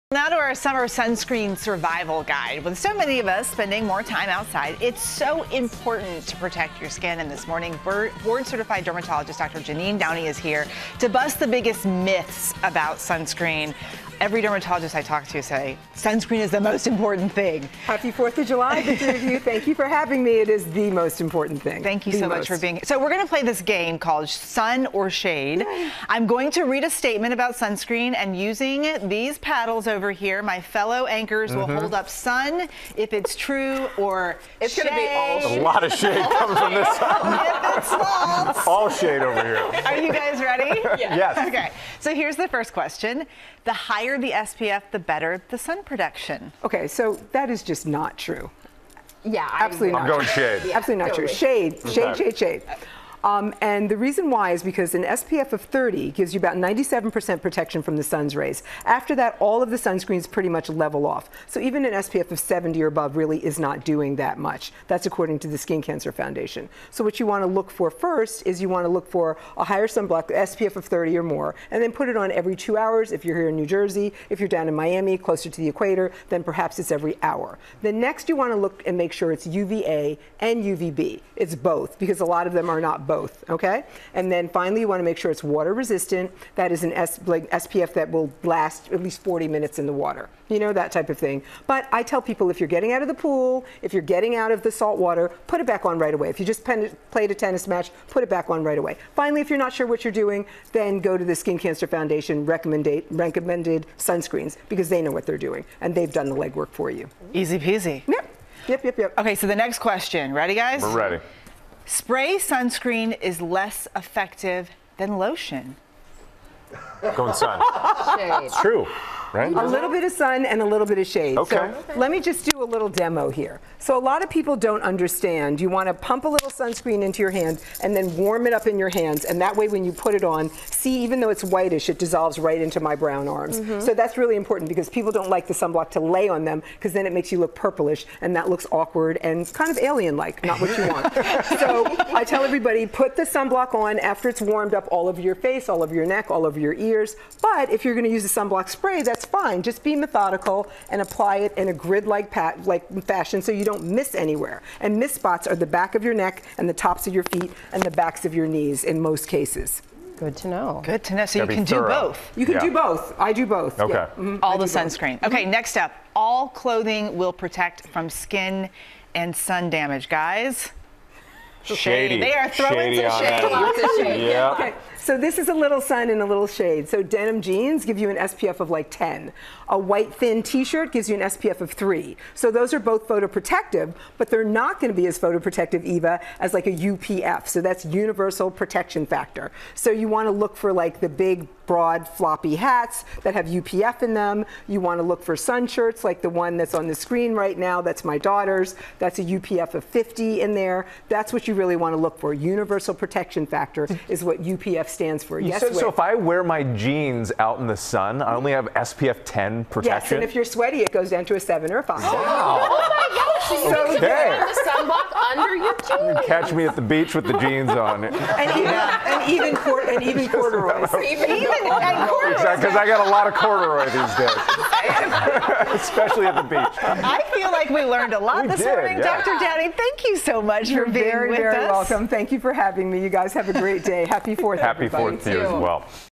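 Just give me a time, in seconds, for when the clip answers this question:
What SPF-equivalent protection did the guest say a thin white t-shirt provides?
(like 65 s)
181 s.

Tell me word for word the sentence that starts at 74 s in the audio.
If you're down in Miami, closer to the equator, then perhaps it's every hour.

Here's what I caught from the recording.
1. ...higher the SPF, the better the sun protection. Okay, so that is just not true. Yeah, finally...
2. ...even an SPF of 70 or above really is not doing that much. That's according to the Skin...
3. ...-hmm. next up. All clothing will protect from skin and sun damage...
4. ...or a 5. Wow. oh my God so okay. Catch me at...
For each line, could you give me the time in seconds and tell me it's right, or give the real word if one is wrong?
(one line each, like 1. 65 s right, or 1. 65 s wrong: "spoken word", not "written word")
1. 43 s wrong: "absolutely", not "finally"
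2. 61 s right
3. 165 s right
4. 211 s right.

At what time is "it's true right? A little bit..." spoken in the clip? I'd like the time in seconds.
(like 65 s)
118 s.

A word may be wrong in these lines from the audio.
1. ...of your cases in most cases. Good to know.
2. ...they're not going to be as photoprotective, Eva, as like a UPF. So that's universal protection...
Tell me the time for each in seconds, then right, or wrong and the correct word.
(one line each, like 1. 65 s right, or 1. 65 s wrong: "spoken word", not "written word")
1. 158 s wrong: "knees", not "cases"
2. 184 s right.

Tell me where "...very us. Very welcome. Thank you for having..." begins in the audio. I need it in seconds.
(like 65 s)
231 s.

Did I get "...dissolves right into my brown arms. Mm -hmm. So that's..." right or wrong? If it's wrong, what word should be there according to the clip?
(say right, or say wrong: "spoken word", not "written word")
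right.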